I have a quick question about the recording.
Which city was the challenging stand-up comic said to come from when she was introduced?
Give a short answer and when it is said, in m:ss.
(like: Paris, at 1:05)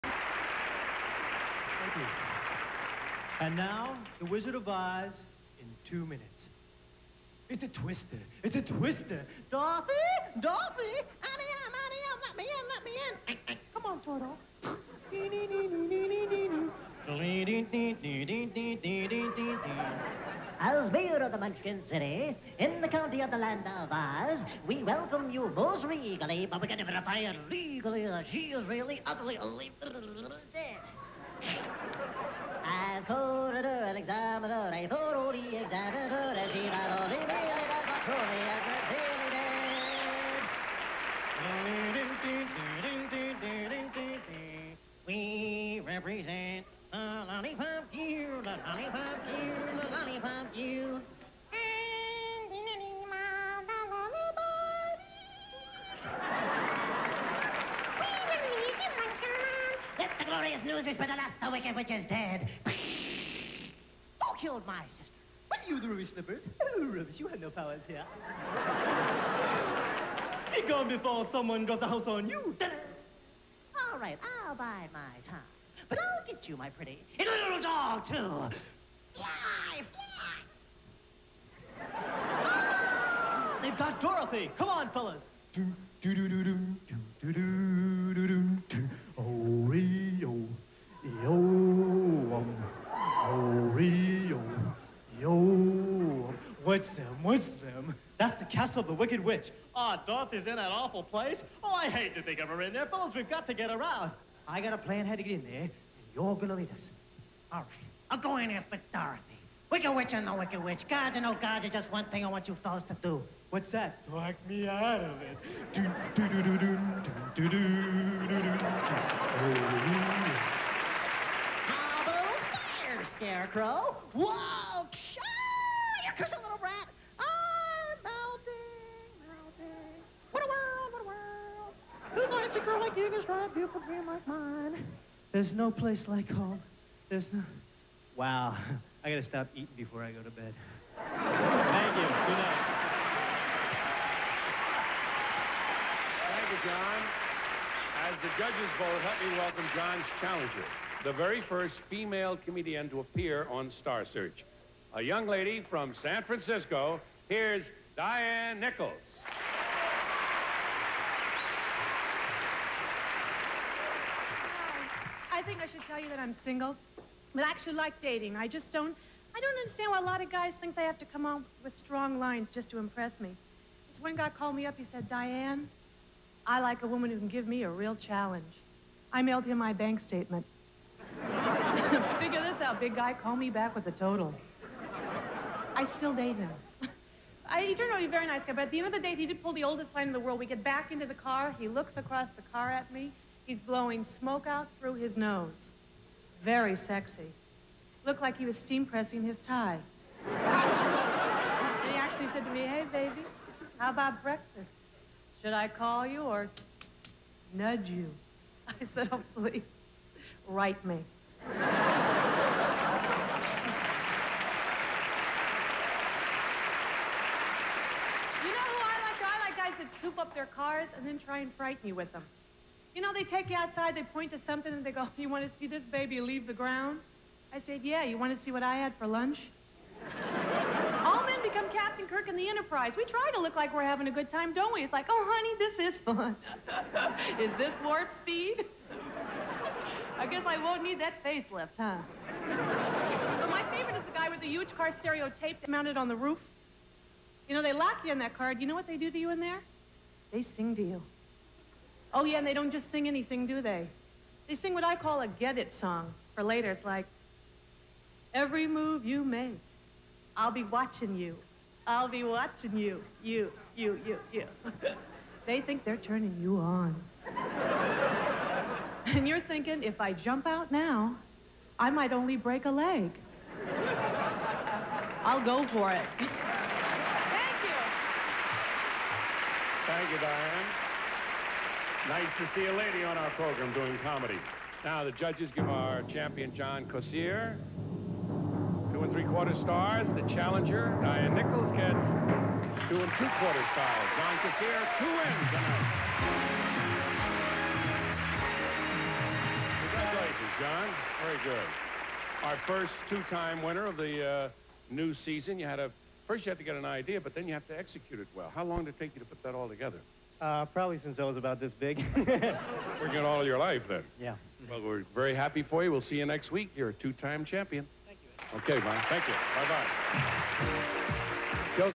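San Francisco, at 2:36.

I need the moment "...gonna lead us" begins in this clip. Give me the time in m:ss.
1:46.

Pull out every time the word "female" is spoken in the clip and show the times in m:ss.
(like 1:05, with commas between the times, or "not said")
2:31.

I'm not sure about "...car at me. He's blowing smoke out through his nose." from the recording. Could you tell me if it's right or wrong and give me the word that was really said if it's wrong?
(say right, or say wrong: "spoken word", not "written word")
right.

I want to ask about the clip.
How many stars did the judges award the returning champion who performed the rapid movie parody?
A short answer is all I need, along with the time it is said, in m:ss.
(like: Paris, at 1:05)
2 and 3/4 stars, at 4:48.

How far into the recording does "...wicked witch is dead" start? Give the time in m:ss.
1:01.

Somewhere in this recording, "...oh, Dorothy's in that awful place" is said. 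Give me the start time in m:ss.
1:39.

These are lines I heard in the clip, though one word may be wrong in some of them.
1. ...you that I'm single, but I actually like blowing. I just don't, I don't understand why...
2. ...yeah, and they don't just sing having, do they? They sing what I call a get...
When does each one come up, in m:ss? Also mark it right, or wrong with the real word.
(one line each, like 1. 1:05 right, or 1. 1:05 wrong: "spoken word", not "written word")
1. 2:45 wrong: "dating", not "blowing"
2. 4:12 wrong: "anything", not "having".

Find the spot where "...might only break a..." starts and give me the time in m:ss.
4:31.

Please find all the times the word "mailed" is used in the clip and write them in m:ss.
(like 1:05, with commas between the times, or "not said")
2:59.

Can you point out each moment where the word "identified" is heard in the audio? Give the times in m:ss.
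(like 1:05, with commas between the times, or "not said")
not said.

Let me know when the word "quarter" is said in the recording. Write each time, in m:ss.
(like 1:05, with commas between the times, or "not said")
4:49, 4:53.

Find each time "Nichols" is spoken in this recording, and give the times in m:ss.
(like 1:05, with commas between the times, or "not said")
2:38, 4:51.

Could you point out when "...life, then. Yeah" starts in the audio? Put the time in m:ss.
5:13.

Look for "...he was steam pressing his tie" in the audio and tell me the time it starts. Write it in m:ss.
3:18.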